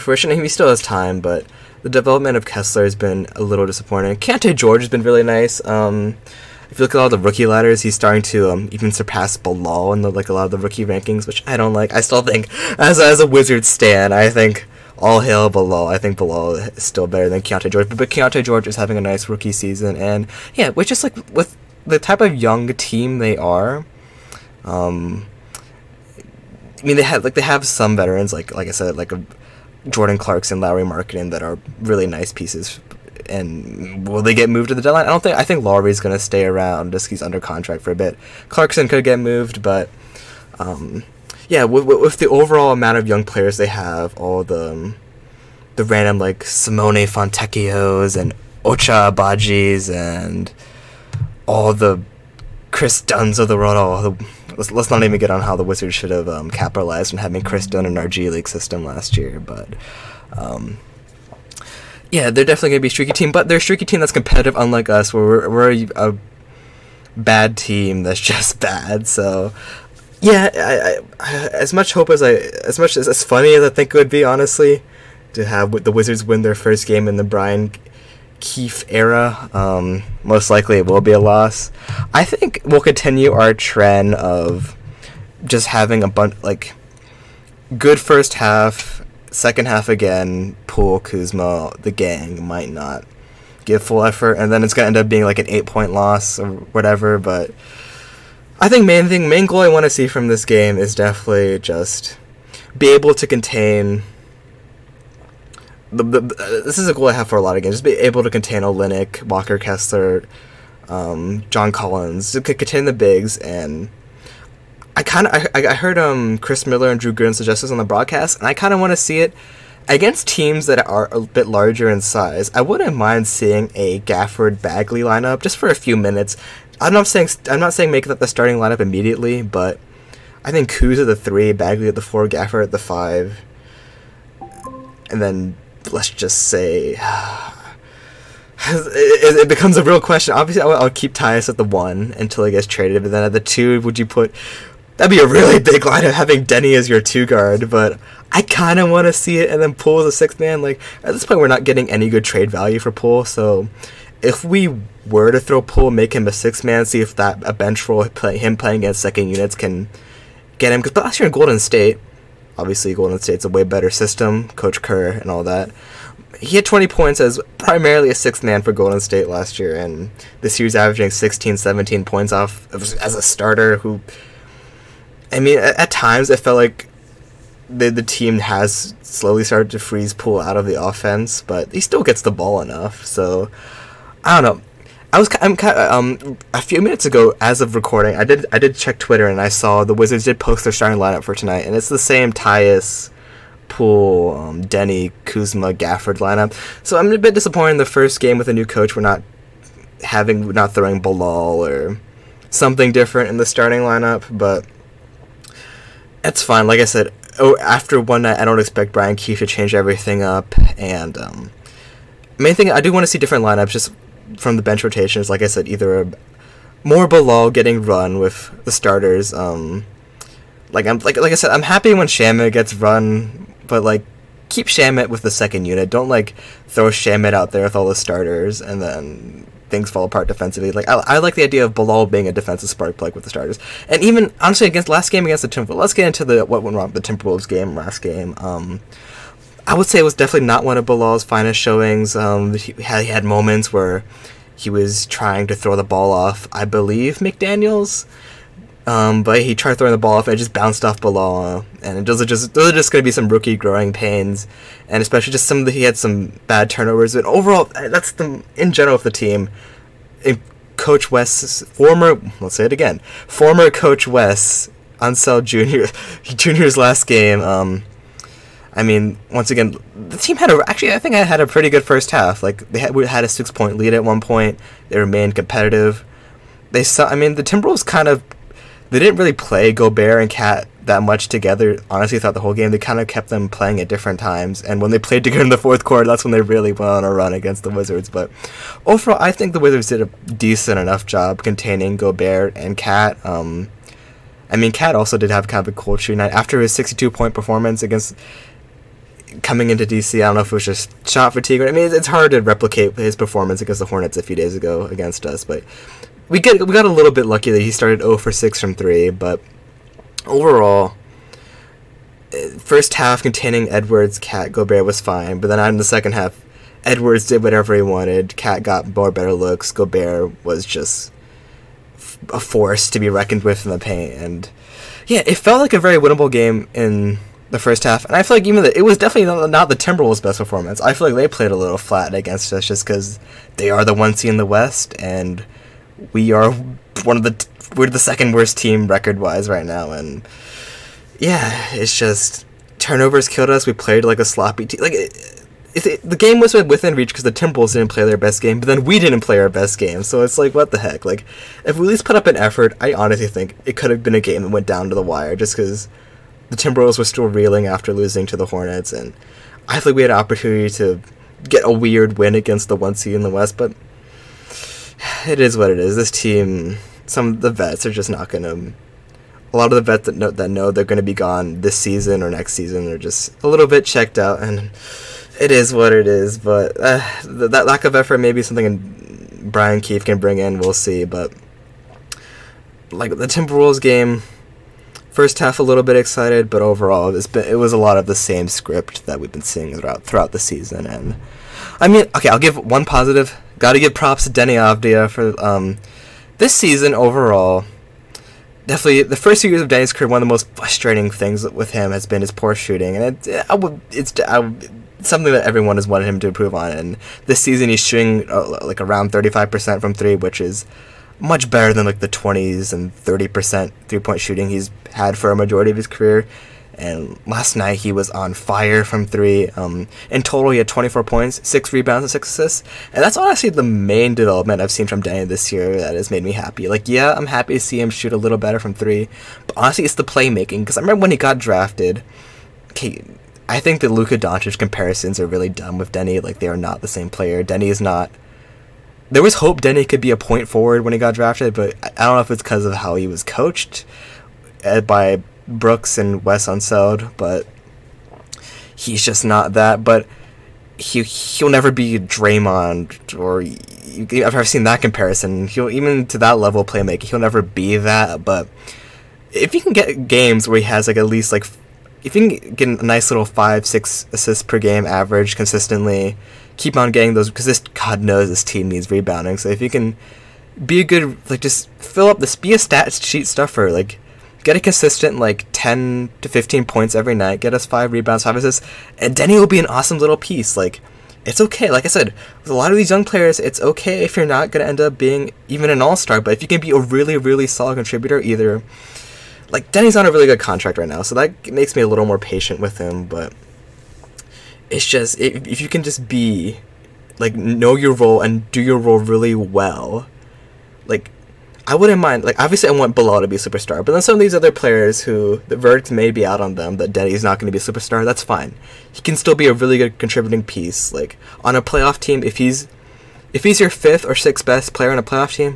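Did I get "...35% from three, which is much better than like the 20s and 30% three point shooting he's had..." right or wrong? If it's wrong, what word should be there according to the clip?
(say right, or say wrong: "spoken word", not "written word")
right.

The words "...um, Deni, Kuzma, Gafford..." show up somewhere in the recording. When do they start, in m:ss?
3:14.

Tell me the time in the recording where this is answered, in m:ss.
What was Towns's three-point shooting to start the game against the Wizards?
5:08.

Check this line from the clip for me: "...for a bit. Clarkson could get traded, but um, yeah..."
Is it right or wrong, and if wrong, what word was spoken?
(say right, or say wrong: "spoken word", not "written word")
wrong: "moved", not "traded".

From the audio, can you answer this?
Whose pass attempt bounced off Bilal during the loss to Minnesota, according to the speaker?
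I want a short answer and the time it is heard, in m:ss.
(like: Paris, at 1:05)
McDaniels, at 4:07.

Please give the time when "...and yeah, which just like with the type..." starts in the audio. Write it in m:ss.
0:19.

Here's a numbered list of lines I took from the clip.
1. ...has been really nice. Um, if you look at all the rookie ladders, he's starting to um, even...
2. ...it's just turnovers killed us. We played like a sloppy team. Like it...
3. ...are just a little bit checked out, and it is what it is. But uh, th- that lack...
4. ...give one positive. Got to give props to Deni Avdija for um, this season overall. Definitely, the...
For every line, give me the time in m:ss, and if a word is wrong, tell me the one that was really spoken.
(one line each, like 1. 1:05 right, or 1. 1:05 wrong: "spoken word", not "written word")
1. 0:04 right
2. 5:41 right
3. 6:12 right
4. 6:32 right.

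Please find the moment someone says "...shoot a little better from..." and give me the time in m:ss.
7:07.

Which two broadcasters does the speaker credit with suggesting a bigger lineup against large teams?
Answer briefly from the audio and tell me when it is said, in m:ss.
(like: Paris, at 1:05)
Chris Miller and Drew Gooden, at 1:56.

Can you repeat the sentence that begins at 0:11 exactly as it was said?
I still think, as as a Wizards stan, I think all hail Bilal.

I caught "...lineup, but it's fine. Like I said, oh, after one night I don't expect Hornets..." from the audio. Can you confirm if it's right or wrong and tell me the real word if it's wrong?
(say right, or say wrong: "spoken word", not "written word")
wrong: "Brian", not "Hornets".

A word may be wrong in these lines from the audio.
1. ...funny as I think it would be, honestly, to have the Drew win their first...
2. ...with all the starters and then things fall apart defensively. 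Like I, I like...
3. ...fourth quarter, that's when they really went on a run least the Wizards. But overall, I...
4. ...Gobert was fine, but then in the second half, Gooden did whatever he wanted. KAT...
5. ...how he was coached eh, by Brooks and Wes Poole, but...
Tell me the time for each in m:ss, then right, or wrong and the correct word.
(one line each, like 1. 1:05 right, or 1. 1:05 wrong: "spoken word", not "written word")
1. 1:13 wrong: "Wizards", not "Drew"
2. 3:47 right
3. 4:45 wrong: "against", not "least"
4. 5:14 wrong: "Edwards", not "Gooden"
5. 7:22 wrong: "Unseld", not "Poole".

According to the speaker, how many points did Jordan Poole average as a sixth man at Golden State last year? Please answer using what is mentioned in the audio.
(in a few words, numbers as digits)
20.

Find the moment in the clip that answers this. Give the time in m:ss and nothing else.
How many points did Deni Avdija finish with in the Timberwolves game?
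7:00.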